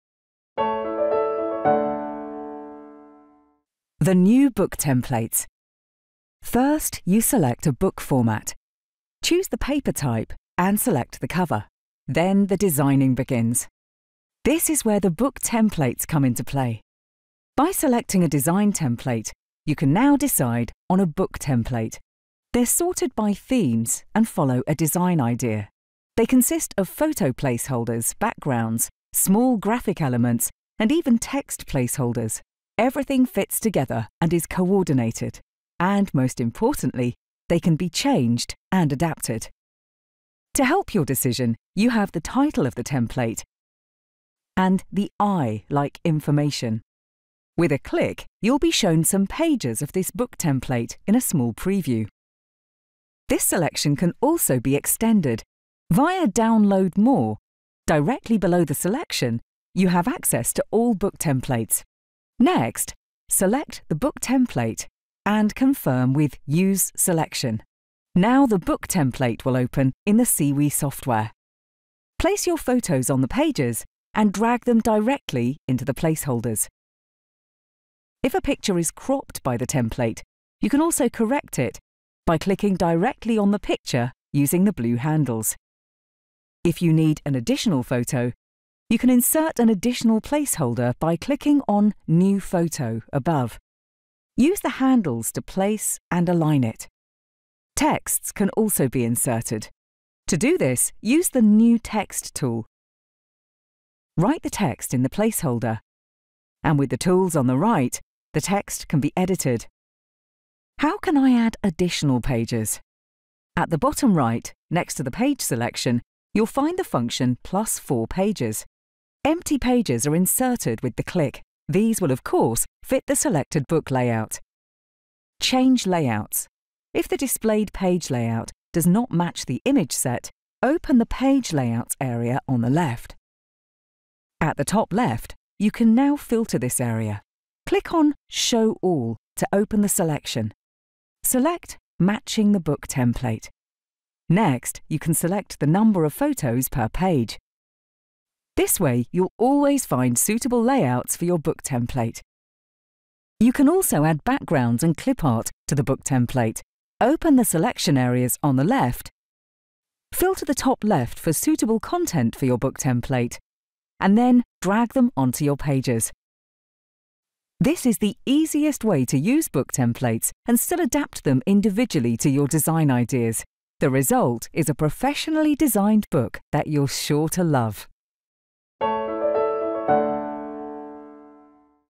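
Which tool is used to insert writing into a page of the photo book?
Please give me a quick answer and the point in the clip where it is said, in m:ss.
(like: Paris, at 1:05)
New Text, at 1:41.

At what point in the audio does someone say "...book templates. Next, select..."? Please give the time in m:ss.
1:00.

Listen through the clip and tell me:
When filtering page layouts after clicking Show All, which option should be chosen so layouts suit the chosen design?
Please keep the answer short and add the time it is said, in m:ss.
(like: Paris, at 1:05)
Matching the Book Template, at 2:21.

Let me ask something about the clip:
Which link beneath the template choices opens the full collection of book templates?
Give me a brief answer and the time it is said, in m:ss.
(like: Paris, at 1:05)
Download More, at 0:56.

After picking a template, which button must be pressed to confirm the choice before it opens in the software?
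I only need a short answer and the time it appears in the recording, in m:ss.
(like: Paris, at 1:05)
Use Selection, at 1:06.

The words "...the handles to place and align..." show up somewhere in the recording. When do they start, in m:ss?
1:34.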